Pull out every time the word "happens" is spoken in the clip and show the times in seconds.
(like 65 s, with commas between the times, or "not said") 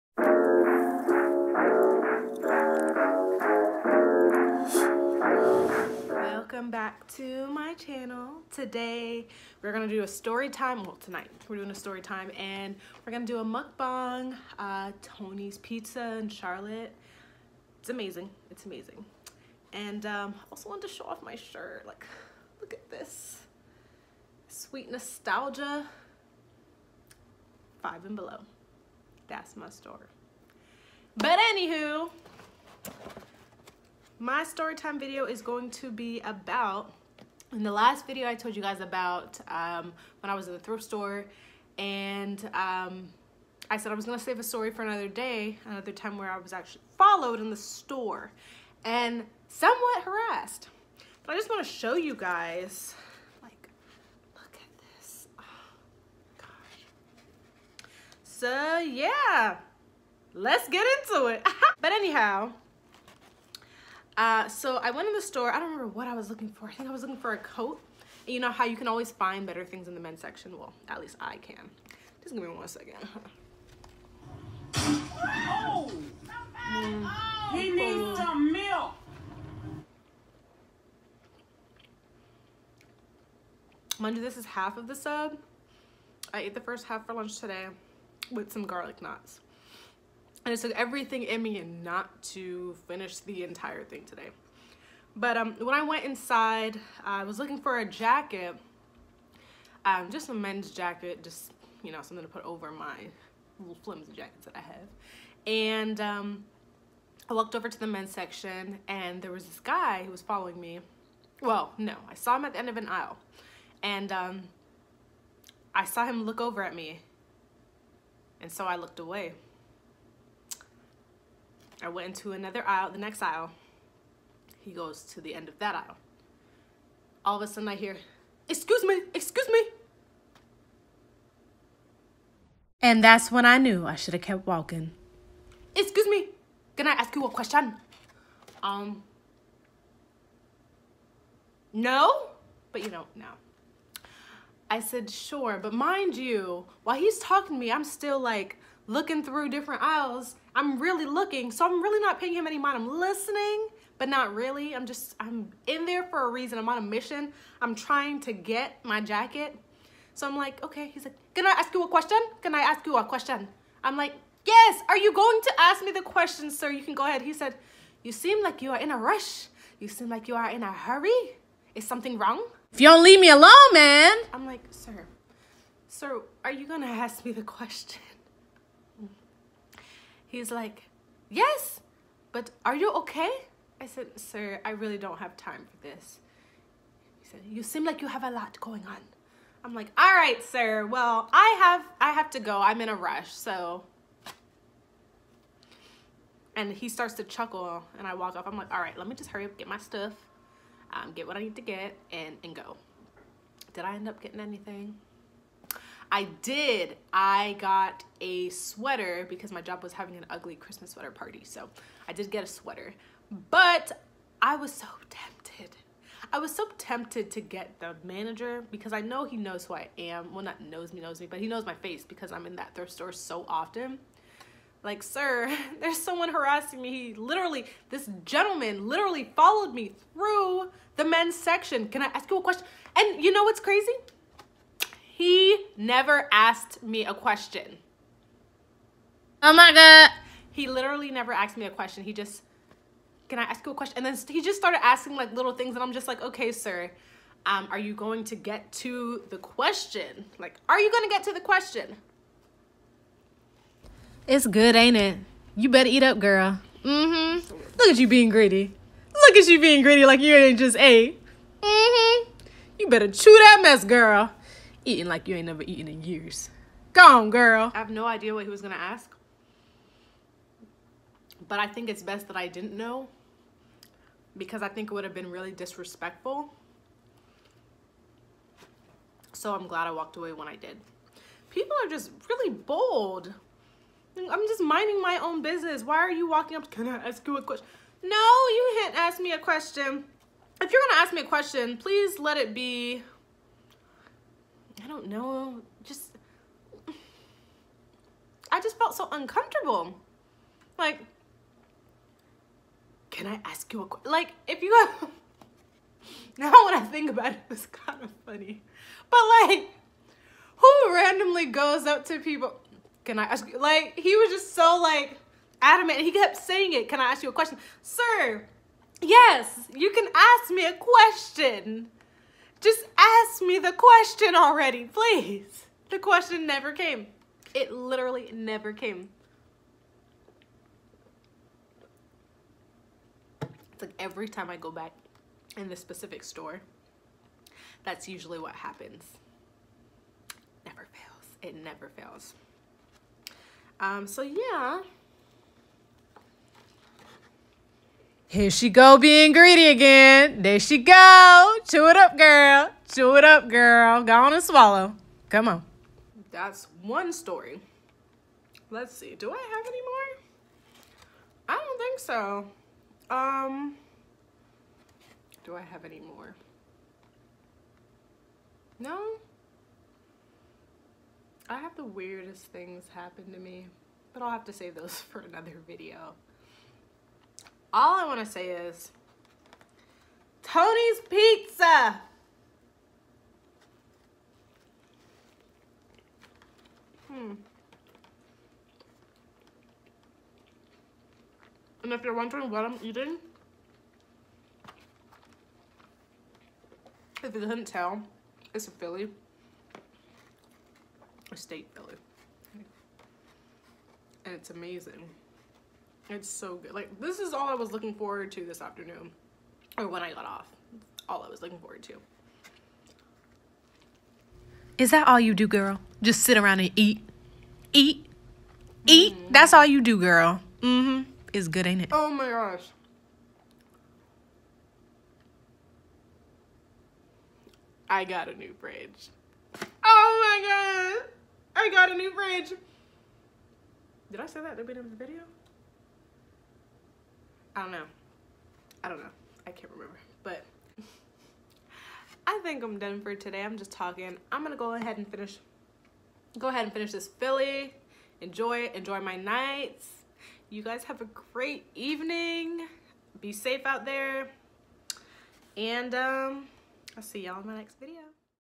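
338 s, 372 s.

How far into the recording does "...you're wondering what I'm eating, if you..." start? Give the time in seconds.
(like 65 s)
392 s.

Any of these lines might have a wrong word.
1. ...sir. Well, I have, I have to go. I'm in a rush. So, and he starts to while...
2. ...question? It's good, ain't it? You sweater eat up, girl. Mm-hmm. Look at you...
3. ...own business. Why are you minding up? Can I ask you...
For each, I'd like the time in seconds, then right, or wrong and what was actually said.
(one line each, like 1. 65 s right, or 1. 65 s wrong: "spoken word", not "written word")
1. 190 s wrong: "chuckle", not "while"
2. 251 s wrong: "better", not "sweater"
3. 285 s wrong: "walking", not "minding".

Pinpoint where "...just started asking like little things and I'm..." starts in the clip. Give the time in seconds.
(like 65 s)
244 s.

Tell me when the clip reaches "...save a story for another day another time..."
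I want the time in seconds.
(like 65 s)
44 s.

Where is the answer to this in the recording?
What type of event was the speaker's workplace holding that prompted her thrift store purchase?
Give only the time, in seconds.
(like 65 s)
210 s.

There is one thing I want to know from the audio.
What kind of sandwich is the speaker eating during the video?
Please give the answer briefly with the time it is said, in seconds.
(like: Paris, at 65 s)
Steak Philly, at 401 s.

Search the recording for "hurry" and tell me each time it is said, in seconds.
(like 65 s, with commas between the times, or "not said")
170 s, 199 s.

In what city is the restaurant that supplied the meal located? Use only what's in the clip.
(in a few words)
Charlotte.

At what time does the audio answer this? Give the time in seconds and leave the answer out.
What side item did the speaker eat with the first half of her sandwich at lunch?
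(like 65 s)
88 s.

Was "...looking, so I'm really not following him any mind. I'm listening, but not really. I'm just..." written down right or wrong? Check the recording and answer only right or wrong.
wrong.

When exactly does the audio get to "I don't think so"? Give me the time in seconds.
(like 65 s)
361 s.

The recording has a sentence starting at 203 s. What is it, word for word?
Did I end up getting anything?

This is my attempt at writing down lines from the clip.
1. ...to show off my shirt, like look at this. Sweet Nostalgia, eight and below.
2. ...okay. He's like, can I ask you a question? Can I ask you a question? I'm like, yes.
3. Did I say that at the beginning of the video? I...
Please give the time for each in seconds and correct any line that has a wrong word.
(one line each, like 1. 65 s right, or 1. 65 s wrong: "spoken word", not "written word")
1. 20 s wrong: "five", not "eight"
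2. 160 s right
3. 434 s right.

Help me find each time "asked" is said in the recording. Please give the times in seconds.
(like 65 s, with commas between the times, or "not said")
236 s, 241 s.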